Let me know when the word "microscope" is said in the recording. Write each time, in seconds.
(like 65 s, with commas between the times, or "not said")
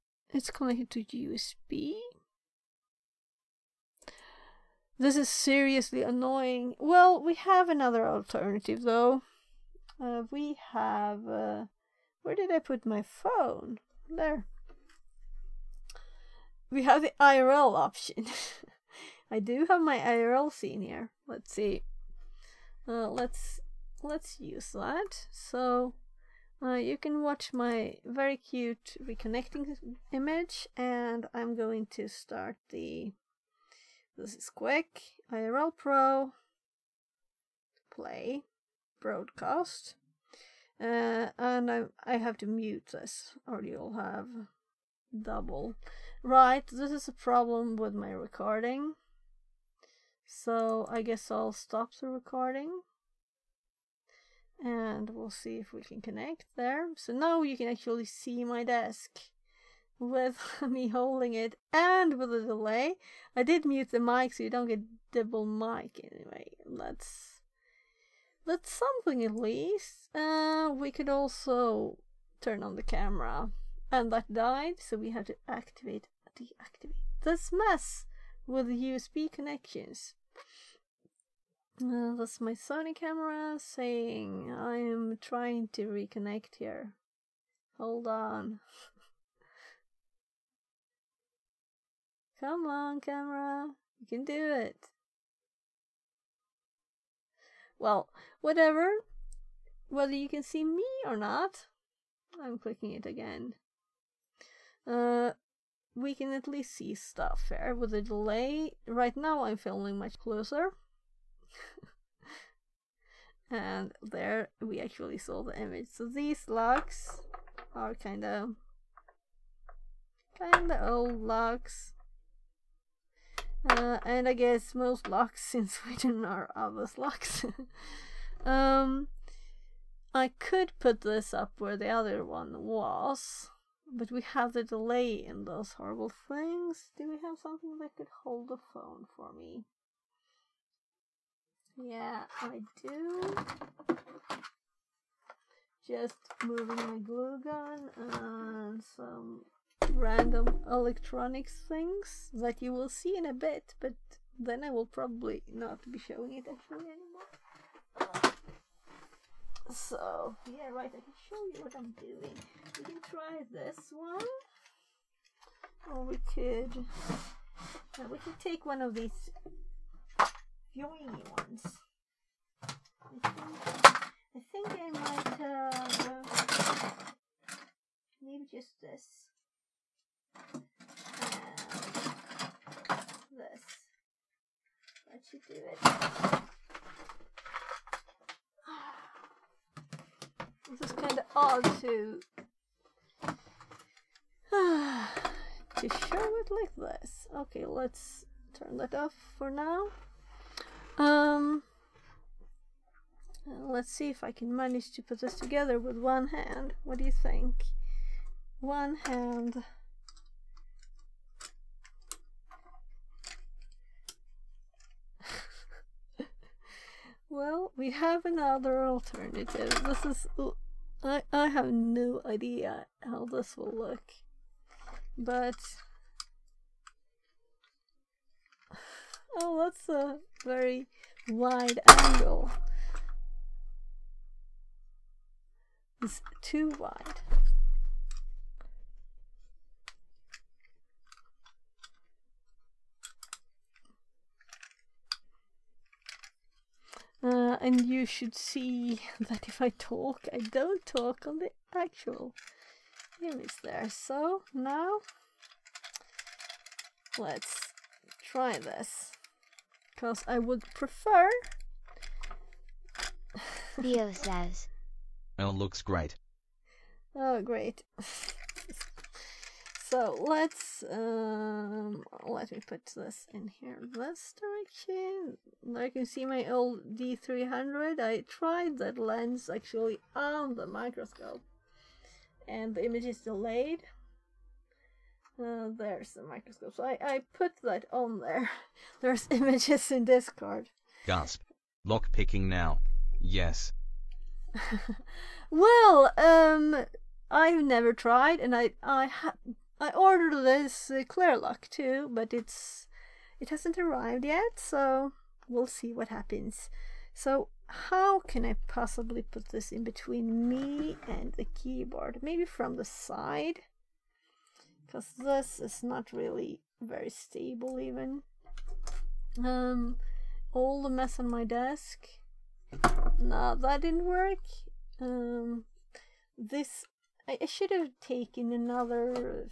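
280 s, 286 s.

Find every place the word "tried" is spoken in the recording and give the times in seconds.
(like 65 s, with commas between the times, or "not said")
278 s, 297 s.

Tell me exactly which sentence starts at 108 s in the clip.
Right now I'm filming much closer and there we actually saw the image.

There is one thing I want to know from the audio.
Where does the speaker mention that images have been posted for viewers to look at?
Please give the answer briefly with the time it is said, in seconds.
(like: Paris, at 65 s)
Discord, at 290 s.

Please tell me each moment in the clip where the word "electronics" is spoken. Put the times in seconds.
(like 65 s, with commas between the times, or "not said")
150 s.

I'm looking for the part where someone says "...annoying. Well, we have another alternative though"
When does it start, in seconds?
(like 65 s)
6 s.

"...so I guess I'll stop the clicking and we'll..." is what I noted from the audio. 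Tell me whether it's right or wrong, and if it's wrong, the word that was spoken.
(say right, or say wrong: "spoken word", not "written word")
wrong: "recording", not "clicking".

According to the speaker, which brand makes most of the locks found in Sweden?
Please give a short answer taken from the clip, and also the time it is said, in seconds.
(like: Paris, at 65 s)
ABUS, at 126 s.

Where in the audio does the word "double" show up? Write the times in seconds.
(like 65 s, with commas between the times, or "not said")
45 s, 65 s.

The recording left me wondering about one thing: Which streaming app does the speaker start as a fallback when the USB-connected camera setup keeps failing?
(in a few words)
IRL Pro.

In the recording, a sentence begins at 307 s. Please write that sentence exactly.
So how can I possibly put this in between me and the keyboard?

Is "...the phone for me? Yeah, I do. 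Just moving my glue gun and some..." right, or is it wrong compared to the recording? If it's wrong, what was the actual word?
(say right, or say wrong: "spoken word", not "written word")
right.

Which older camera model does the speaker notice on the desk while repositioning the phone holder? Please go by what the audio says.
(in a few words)
D300.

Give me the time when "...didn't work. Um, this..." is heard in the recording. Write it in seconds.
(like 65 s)
323 s.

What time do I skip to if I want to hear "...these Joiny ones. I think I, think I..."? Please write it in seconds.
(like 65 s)
168 s.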